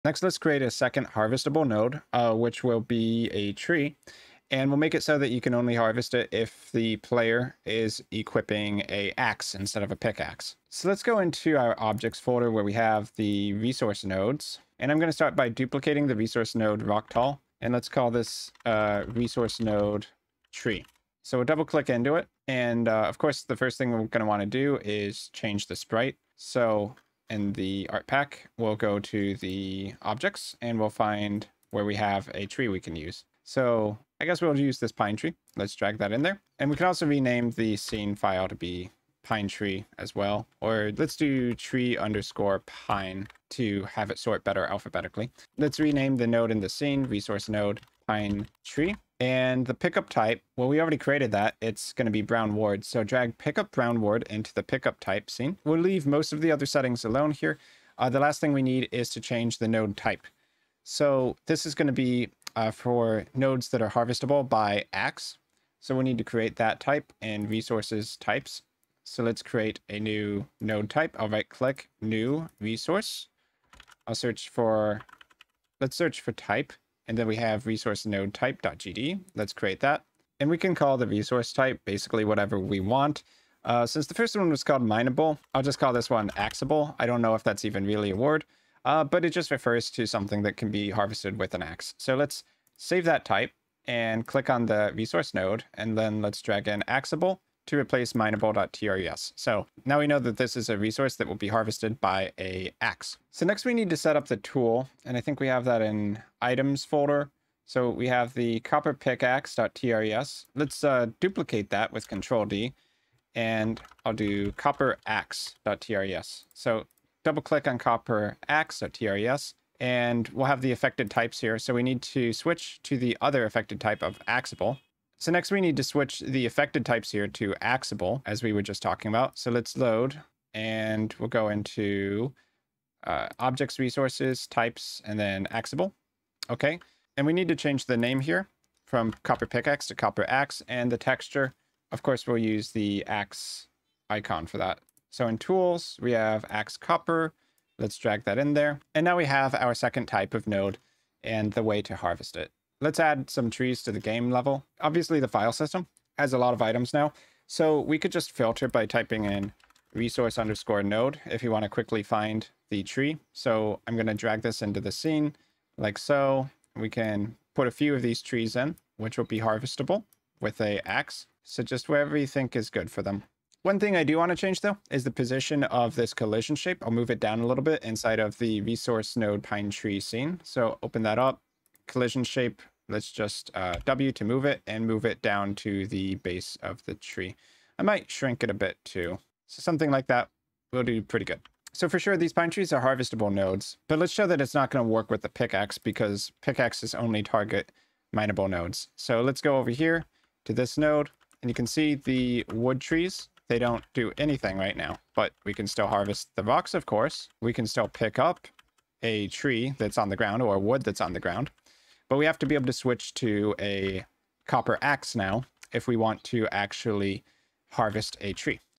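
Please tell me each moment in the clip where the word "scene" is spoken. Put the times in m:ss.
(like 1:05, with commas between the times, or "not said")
0:37, 0:46, 0:55, 2:44, 2:59.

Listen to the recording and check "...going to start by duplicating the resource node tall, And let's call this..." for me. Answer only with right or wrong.
right.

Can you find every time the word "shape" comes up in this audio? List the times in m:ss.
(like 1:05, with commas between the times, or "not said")
2:56, 3:02.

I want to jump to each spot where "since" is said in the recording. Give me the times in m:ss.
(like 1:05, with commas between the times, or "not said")
1:23.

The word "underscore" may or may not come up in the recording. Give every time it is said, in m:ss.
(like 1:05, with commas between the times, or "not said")
0:41, 2:40.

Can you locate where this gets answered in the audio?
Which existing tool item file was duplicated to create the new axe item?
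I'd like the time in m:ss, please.
1:48.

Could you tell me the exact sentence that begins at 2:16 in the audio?
Okay, and we need to change the name here from copper pickaxe to copper axe, and the texture.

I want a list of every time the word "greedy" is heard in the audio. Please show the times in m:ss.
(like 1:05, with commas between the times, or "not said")
not said.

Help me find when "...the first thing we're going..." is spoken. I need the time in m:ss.
0:23.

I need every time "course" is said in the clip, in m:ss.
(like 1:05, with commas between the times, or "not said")
0:23, 2:22, 3:26.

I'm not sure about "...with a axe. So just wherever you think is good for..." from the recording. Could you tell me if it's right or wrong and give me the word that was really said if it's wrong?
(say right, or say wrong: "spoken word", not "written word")
right.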